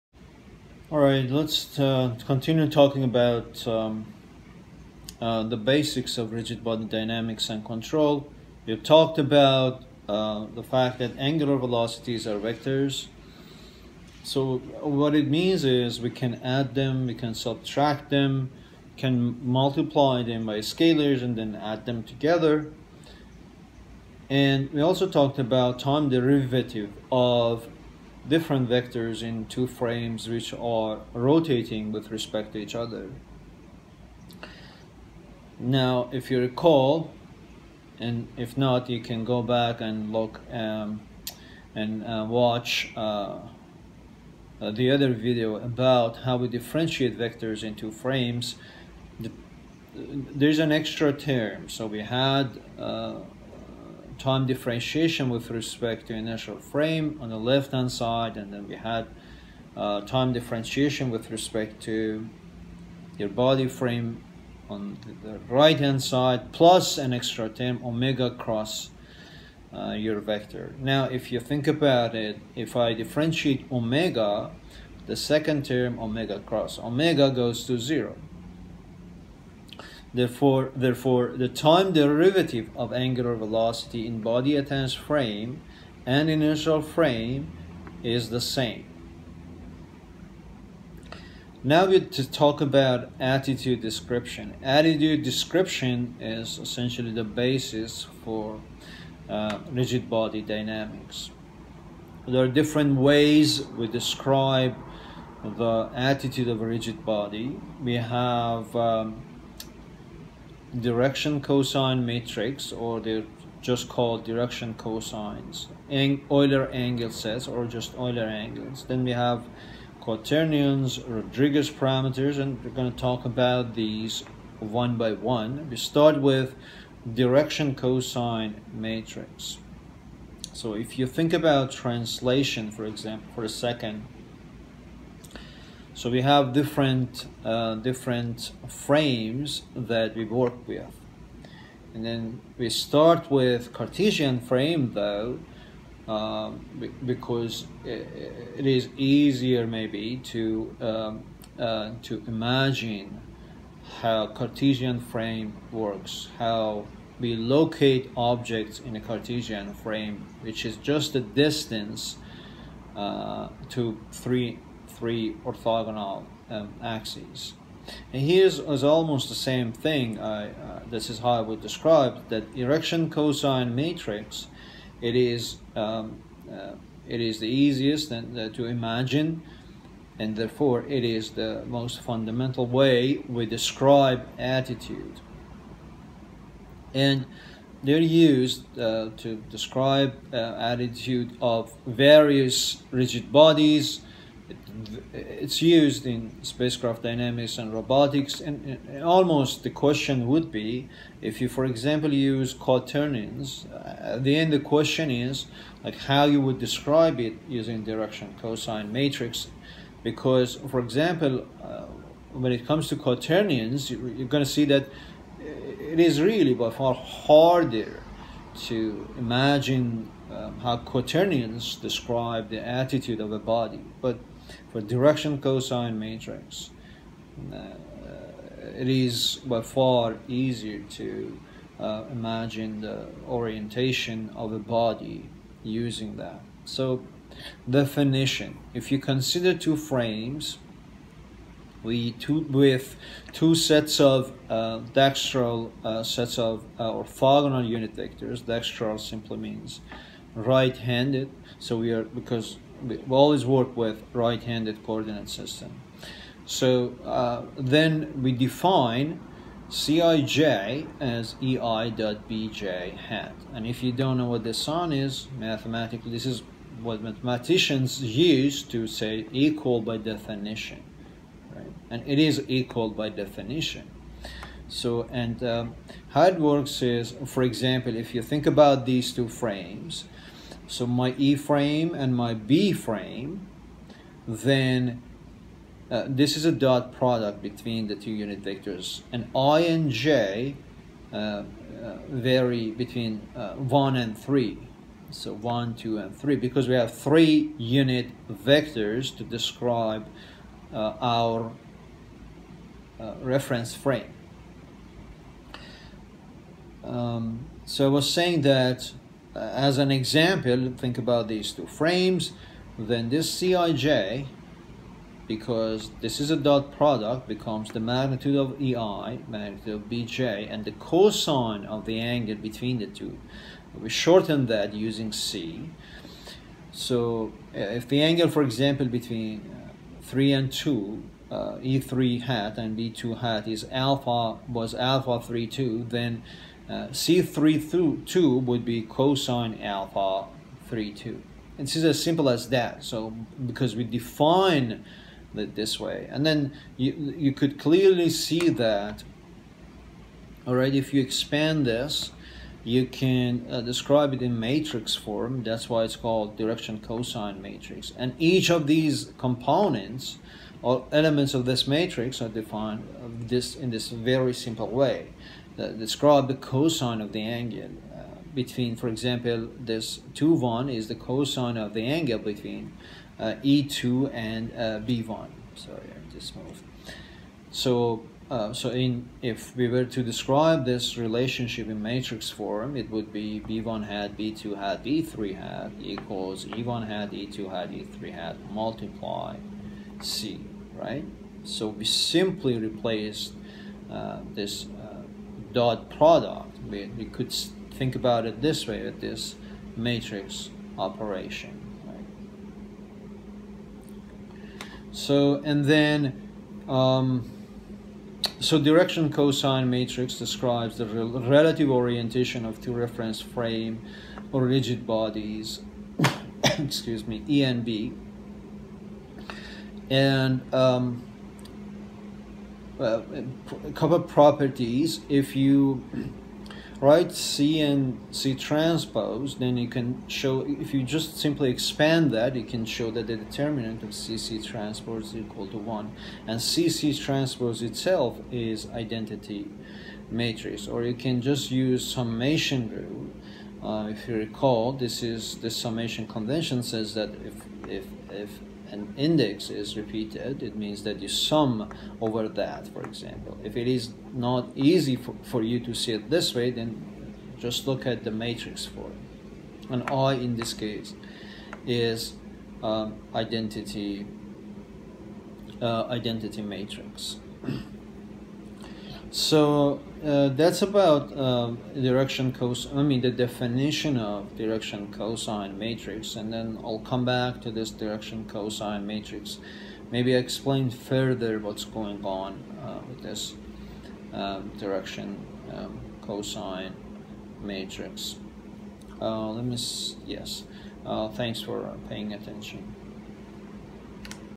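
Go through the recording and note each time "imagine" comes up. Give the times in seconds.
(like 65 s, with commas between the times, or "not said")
152 s, 178 s, 219 s, 232 s.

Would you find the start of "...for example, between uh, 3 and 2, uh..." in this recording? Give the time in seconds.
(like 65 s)
328 s.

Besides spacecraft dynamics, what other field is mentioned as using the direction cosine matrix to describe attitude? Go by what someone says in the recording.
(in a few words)
robotics.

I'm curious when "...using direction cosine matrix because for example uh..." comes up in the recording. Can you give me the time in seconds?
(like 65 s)
207 s.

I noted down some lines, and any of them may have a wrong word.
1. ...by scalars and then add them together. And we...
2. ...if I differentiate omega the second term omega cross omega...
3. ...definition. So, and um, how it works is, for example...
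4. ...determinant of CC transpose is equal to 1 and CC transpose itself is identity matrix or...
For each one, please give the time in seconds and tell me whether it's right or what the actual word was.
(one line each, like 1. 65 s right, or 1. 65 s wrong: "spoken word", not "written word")
1. 20 s right
2. 72 s right
3. 273 s right
4. 433 s right.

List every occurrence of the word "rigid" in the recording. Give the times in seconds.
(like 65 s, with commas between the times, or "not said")
6 s, 99 s, 106 s, 192 s, 414 s.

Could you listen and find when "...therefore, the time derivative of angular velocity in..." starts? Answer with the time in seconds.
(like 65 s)
80 s.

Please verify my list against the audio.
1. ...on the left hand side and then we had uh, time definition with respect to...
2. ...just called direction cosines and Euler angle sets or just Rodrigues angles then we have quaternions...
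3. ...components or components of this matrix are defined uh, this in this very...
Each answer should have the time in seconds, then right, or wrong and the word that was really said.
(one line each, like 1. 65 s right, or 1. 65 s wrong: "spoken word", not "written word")
1. 57 s wrong: "differentiation", not "definition"
2. 113 s wrong: "Euler", not "Rodrigues"
3. 359 s wrong: "elements", not "components".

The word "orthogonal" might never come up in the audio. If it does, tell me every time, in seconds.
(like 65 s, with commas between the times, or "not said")
165 s, 246 s.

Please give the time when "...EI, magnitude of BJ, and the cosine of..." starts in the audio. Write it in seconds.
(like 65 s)
318 s.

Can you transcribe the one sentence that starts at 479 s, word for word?
Maybe I explain further what's going on uh, with this um, direction um, cosine matrix.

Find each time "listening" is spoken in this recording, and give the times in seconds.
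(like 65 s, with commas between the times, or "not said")
not said.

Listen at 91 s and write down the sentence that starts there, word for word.
Now we to talk about attitude description.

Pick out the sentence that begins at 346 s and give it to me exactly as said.
And then you, you could clearly see that, all right, if you expand this, you can uh, describe it in matrix form.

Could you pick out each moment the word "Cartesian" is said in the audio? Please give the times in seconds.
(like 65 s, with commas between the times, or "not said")
143 s, 154 s, 159 s.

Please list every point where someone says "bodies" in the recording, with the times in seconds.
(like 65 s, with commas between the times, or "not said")
193 s, 414 s.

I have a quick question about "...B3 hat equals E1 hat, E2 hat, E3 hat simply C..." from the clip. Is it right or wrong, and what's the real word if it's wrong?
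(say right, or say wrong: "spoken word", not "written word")
wrong: "multiply", not "simply".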